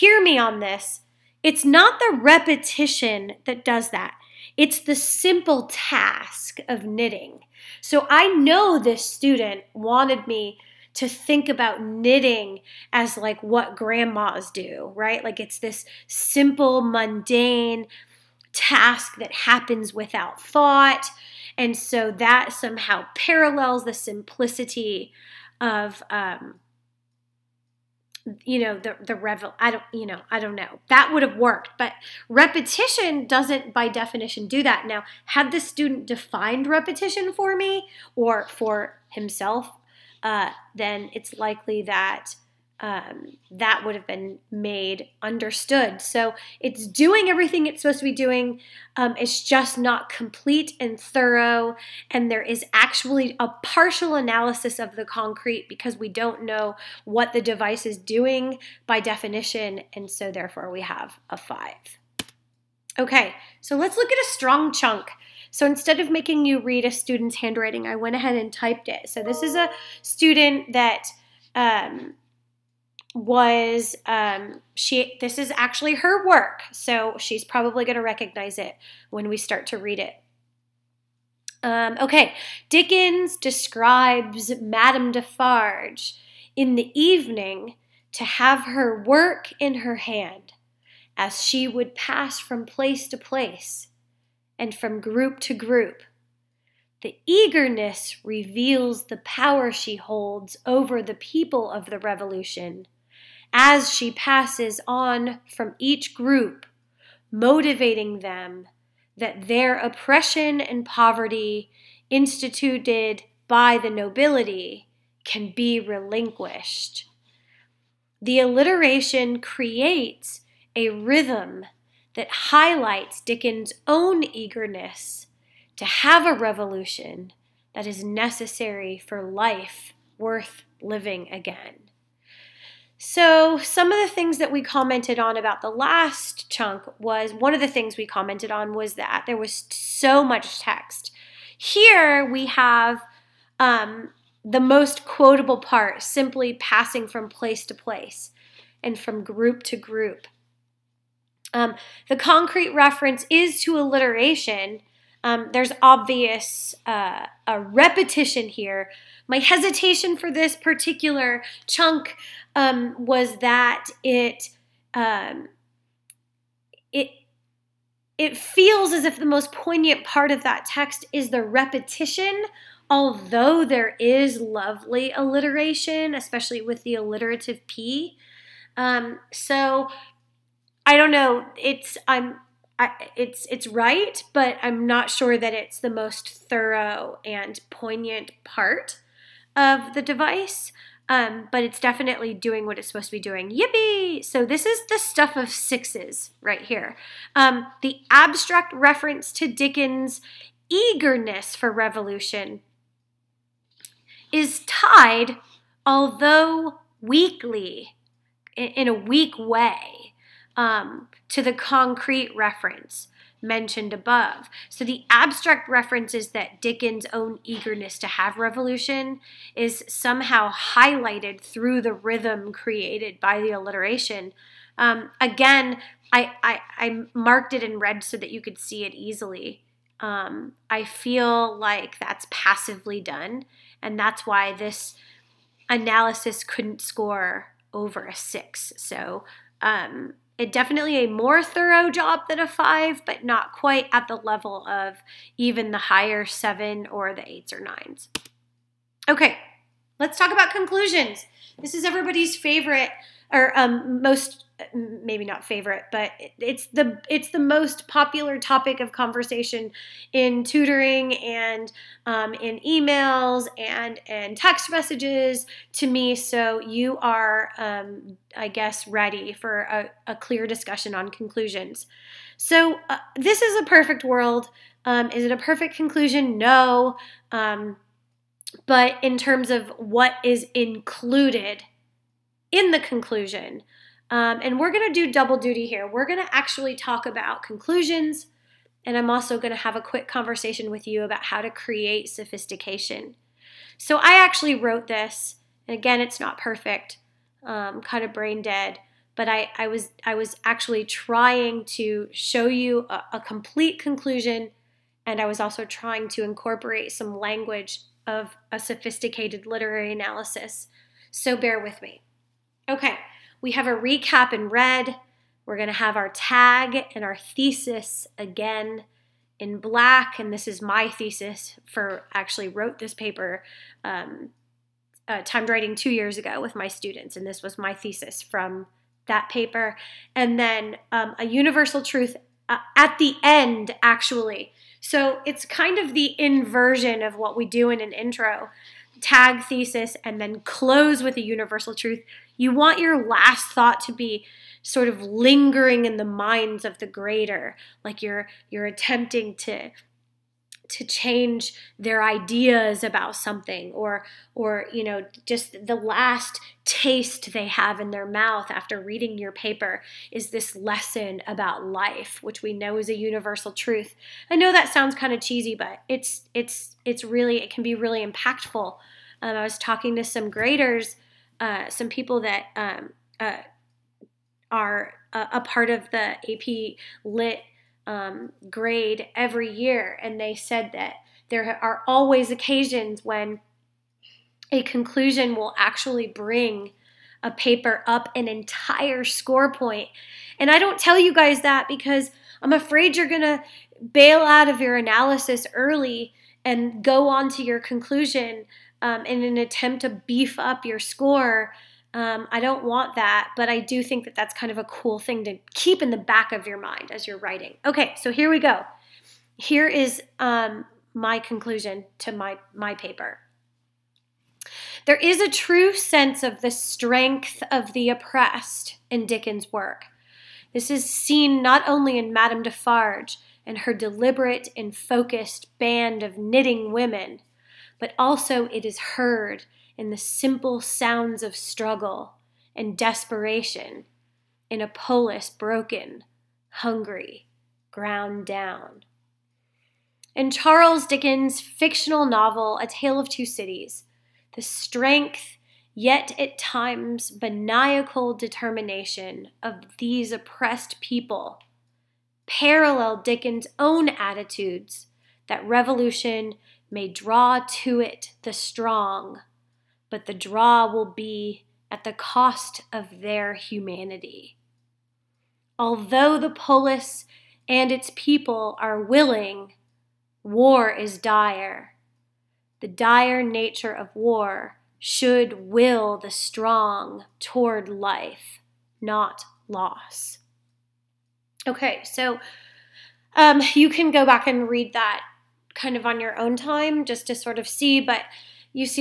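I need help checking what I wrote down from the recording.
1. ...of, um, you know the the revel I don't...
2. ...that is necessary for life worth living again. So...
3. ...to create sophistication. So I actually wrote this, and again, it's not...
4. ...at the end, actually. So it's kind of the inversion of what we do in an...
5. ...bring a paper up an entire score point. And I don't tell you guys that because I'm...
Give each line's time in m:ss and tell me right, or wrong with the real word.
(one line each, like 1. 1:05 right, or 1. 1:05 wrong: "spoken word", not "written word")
1. 0:25 right
2. 2:07 right
3. 4:51 right
4. 5:32 right
5. 6:26 right.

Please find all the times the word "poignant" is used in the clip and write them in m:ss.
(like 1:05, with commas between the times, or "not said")
2:49, 3:07.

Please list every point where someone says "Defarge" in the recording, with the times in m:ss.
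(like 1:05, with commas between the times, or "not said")
1:25, 7:02.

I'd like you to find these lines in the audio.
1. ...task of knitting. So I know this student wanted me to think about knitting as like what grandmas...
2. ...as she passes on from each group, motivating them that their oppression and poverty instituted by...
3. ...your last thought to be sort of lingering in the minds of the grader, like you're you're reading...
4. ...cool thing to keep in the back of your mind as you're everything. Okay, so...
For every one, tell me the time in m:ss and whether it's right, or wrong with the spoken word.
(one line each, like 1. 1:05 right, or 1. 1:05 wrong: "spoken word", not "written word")
1. 0:05 right
2. 1:43 right
3. 5:42 wrong: "attempting", not "reading"
4. 6:44 wrong: "writing", not "everything".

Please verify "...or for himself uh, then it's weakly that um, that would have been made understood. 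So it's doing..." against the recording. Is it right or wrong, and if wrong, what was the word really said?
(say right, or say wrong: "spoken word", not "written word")
wrong: "likely", not "weakly".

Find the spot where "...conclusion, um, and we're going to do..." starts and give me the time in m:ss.
4:42.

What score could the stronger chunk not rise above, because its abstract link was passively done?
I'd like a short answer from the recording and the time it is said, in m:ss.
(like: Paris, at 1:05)
6, at 3:58.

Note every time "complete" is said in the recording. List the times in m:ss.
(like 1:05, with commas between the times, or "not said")
0:50, 5:03.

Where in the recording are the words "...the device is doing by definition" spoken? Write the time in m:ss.
0:57.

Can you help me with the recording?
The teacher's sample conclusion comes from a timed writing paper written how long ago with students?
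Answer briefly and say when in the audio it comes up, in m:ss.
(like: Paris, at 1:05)
2 years ago, at 5:25.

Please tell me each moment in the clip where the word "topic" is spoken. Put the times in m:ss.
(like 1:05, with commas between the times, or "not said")
4:18.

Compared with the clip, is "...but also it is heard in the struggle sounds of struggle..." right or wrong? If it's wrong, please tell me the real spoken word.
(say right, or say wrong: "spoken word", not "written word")
wrong: "simple", not "struggle".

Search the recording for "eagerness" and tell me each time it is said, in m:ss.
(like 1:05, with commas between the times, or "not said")
1:37, 2:04, 3:20, 3:37.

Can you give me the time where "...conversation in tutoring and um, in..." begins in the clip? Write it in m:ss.
4:18.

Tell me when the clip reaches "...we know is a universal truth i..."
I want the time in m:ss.
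6:02.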